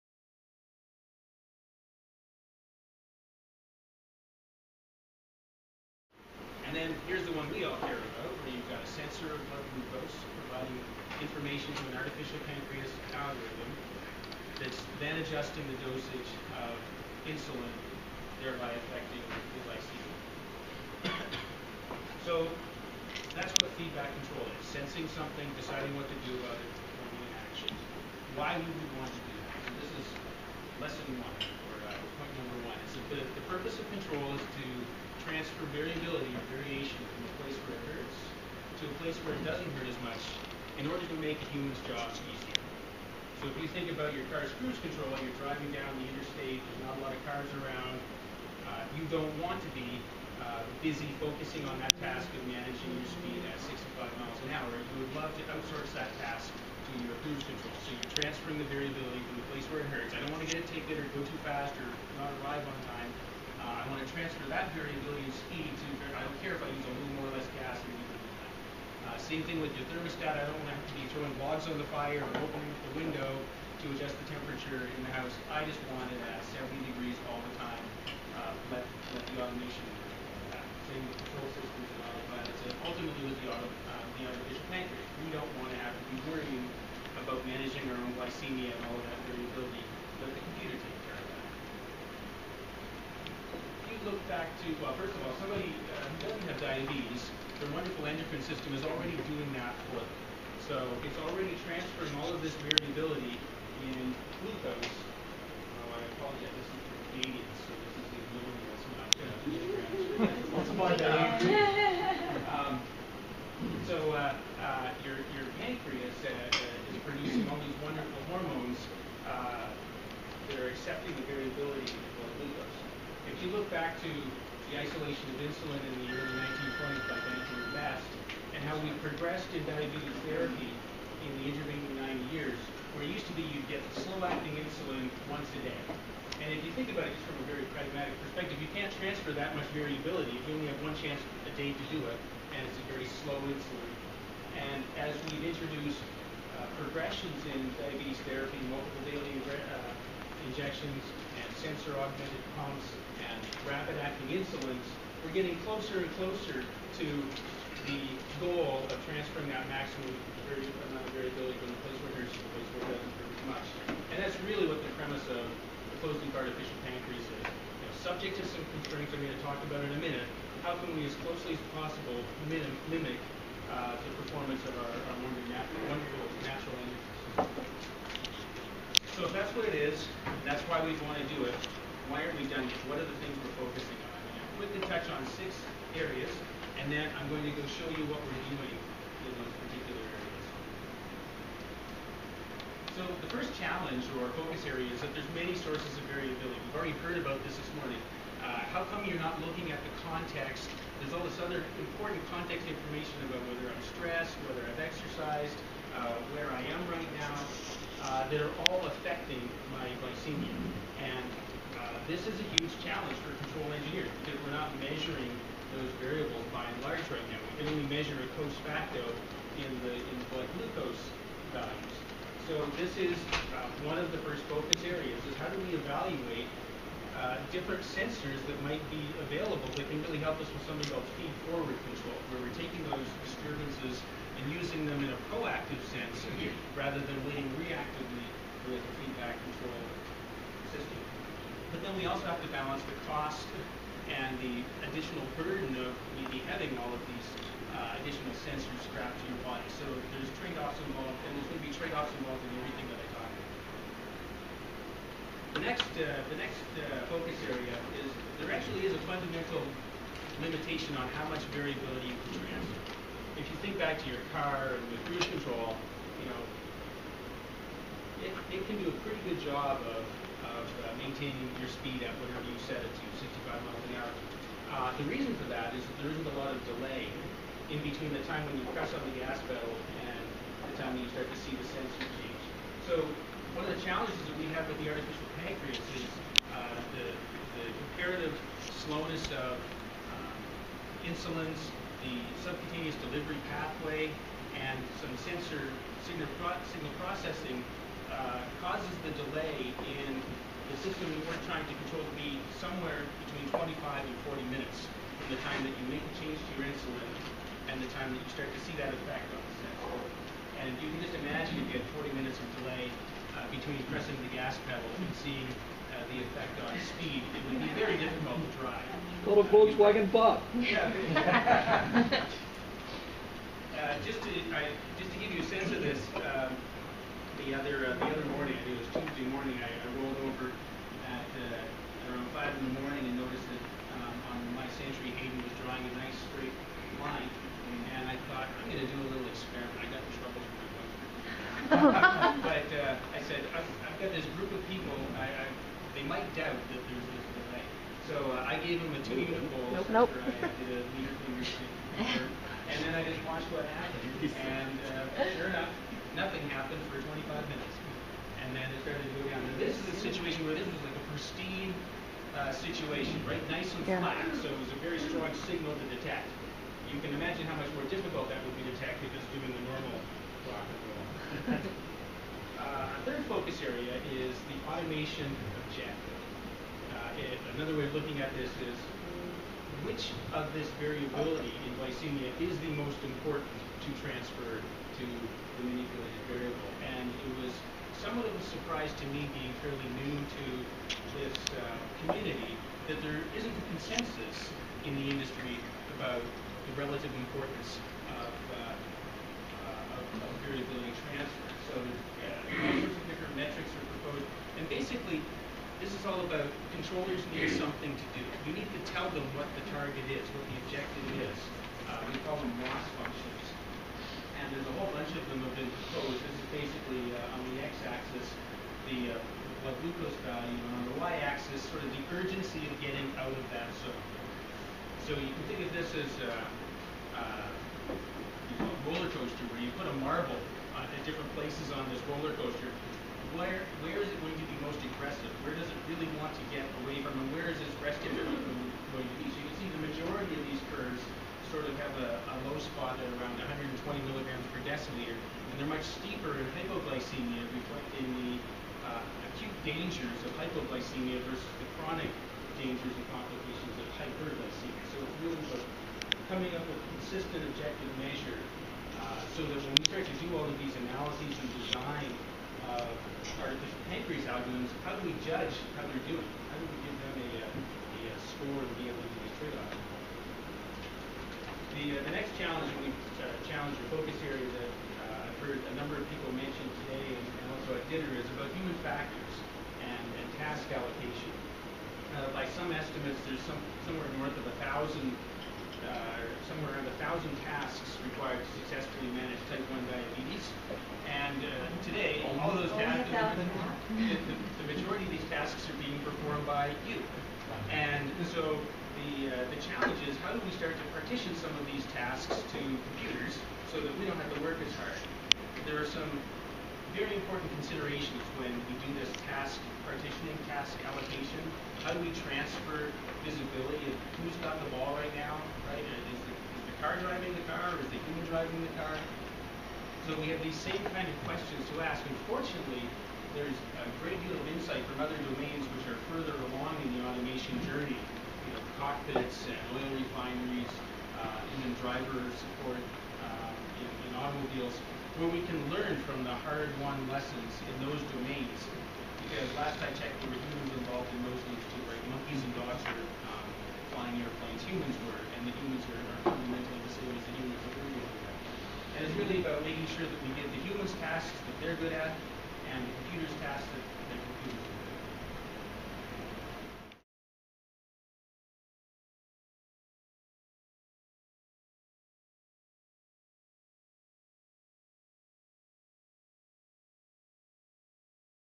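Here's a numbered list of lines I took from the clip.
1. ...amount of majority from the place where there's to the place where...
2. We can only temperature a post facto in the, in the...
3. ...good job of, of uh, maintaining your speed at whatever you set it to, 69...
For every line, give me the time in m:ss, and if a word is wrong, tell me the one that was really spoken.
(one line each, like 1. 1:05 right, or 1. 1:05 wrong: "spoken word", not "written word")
1. 2:40 wrong: "variability", not "majority"
2. 3:37 wrong: "measure", not "temperature"
3. 4:29 wrong: "65", not "69".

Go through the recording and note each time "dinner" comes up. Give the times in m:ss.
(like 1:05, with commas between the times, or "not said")
7:57.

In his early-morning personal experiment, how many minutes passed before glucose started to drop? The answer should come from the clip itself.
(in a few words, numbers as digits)
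25.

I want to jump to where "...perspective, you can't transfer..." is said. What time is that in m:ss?
2:18.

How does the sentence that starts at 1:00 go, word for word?
I don't want to get a ticket or go too fast or not arrive on time.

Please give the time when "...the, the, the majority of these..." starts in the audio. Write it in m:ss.
8:13.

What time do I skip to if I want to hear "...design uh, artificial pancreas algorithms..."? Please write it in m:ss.
7:41.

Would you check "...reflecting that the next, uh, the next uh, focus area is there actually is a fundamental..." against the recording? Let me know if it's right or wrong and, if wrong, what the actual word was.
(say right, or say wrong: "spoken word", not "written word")
wrong: "everything", not "reflecting".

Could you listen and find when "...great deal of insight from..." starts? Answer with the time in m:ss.
8:44.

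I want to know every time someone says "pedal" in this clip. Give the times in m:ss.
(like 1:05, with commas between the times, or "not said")
4:39, 5:14.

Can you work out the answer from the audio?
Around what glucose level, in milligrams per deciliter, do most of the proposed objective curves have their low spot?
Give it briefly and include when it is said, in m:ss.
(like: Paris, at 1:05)
120, at 7:23.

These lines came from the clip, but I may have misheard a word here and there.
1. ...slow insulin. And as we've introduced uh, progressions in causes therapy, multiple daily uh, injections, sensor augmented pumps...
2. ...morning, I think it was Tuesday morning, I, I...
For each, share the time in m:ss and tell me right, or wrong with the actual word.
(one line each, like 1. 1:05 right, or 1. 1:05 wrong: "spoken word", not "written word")
1. 2:23 wrong: "diabetes", not "causes"
2. 5:28 right.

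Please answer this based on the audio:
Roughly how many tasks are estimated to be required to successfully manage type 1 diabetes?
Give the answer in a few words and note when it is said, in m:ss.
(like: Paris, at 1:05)
1,000, at 8:07.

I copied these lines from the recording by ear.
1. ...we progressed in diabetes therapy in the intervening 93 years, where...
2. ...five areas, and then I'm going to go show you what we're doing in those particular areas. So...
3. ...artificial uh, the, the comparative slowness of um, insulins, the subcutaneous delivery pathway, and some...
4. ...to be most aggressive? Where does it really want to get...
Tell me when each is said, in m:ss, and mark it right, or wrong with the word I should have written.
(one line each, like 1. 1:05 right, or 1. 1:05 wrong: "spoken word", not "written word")
1. 2:08 wrong: "90", not "93"
2. 3:05 wrong: "six", not "five"
3. 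4:44 right
4. 7:14 right.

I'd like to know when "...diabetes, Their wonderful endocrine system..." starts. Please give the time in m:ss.
1:36.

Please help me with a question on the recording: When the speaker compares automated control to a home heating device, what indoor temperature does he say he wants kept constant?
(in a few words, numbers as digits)
70 degrees.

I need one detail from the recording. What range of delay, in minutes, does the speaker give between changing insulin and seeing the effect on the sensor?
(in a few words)
25 to 40 minutes.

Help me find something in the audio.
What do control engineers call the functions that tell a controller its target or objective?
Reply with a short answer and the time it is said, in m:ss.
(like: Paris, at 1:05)
loss functions, at 6:52.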